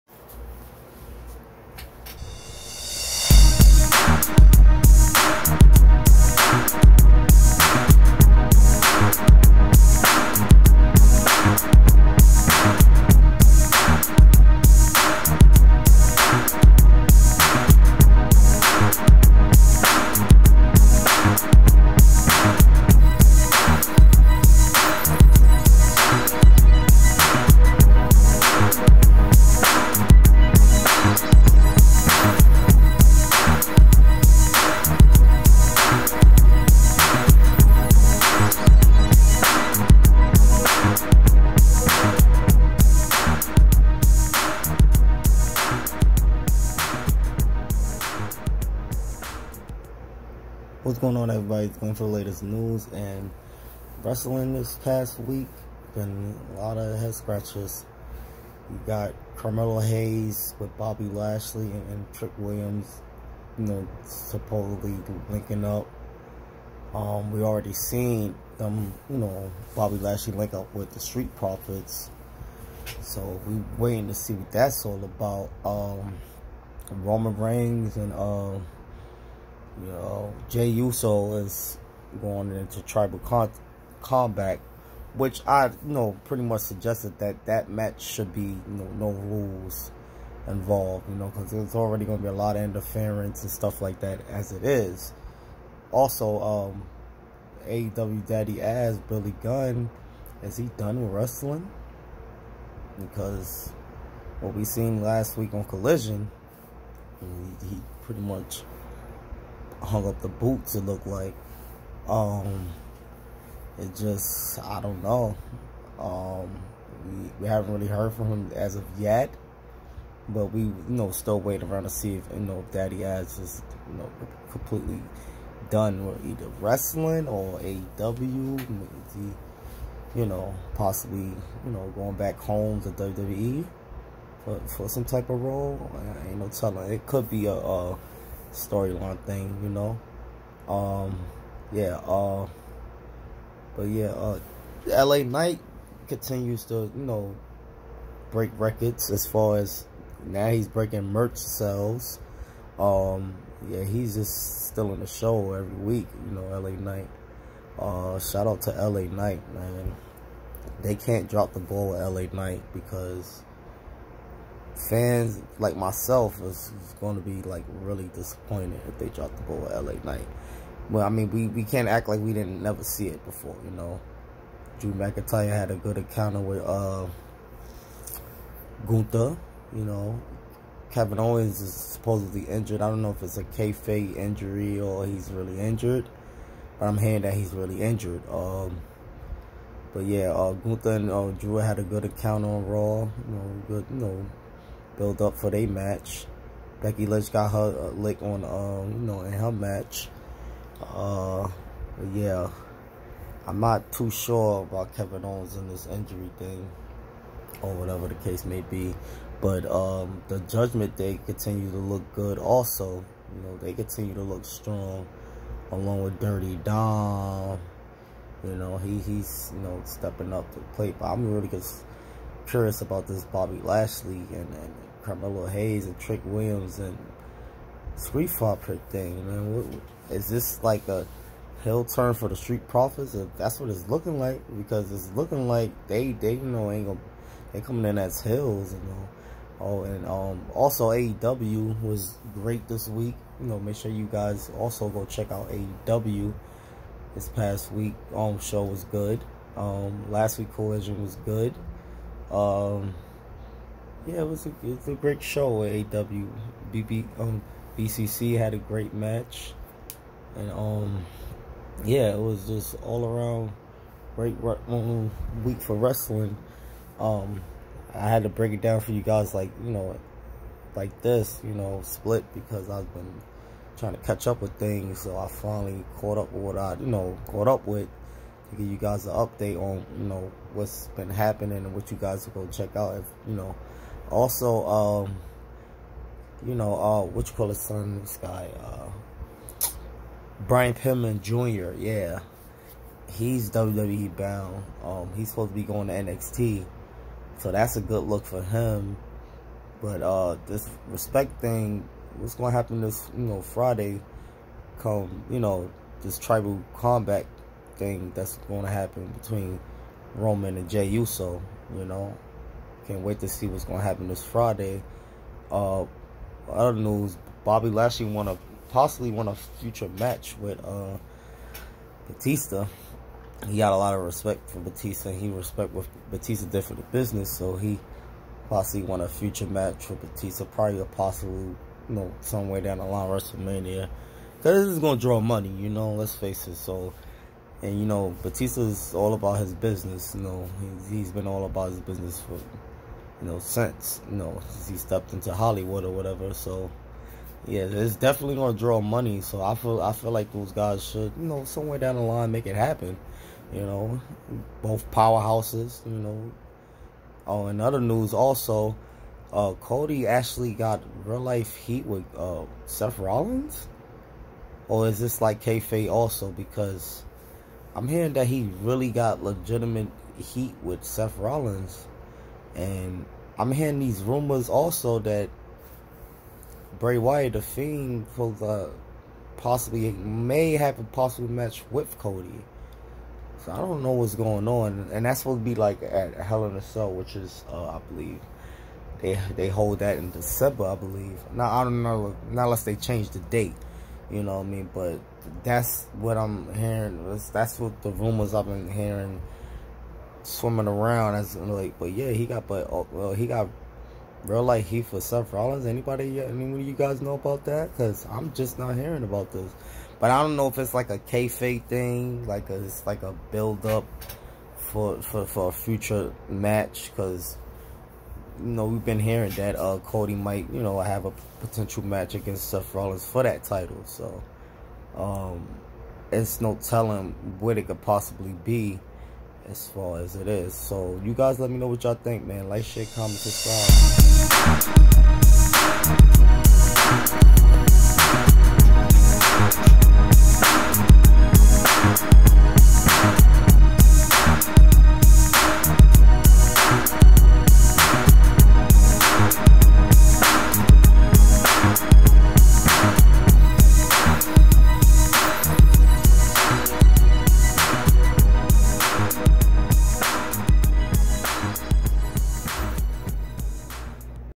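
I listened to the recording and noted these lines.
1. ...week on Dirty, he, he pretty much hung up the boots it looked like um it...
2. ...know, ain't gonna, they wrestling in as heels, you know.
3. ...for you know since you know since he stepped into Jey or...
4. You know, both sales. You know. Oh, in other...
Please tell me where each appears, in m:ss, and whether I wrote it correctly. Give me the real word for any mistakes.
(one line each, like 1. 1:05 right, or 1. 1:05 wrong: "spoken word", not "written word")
1. 1:45 wrong: "Collision", not "Dirty"
2. 3:56 wrong: "coming", not "wrestling"
3. 5:42 wrong: "Hollywood", not "Jey"
4. 5:53 wrong: "powerhouses", not "sales".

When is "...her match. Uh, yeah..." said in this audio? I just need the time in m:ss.
3:19.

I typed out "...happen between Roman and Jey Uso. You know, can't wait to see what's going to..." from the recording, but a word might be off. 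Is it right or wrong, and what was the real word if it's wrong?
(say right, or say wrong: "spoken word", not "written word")
right.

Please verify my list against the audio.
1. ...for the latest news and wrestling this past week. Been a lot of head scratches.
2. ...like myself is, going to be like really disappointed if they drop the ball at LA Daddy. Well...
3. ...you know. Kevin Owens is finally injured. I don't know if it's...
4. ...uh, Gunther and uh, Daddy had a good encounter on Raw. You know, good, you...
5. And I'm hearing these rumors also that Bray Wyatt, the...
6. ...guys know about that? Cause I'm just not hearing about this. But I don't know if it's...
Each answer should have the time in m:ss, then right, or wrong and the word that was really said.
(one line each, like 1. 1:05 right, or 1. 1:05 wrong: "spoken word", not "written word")
1. 0:51 right
2. 2:45 wrong: "Knight", not "Daddy"
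3. 2:59 wrong: "supposedly", not "finally"
4. 3:10 wrong: "Drew", not "Daddy"
5. 6:12 right
6. 6:46 right.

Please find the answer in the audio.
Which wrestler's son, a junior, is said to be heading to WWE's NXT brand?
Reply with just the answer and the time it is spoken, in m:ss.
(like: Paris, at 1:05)
Brian Pillman Jr., at 4:50.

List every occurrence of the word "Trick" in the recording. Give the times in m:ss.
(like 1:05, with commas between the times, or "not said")
1:02, 3:45.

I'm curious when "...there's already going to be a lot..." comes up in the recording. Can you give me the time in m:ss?
1:31.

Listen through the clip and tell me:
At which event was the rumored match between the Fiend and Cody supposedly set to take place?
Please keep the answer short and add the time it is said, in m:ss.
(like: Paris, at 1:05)
Hell in a Cell, at 6:26.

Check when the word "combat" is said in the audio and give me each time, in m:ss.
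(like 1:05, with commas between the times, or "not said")
1:24, 5:06.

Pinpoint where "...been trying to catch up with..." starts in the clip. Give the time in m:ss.
4:32.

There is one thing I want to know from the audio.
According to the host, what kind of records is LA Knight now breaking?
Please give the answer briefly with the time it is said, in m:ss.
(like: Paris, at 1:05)
Merch sales, at 2:31.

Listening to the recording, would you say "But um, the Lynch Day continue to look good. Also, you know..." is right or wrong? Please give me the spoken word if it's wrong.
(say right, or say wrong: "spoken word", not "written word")
wrong: "Judgment", not "Lynch".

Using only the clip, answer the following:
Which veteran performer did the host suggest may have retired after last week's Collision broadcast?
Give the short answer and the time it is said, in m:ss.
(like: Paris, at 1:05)
Billy Gunn, at 1:39.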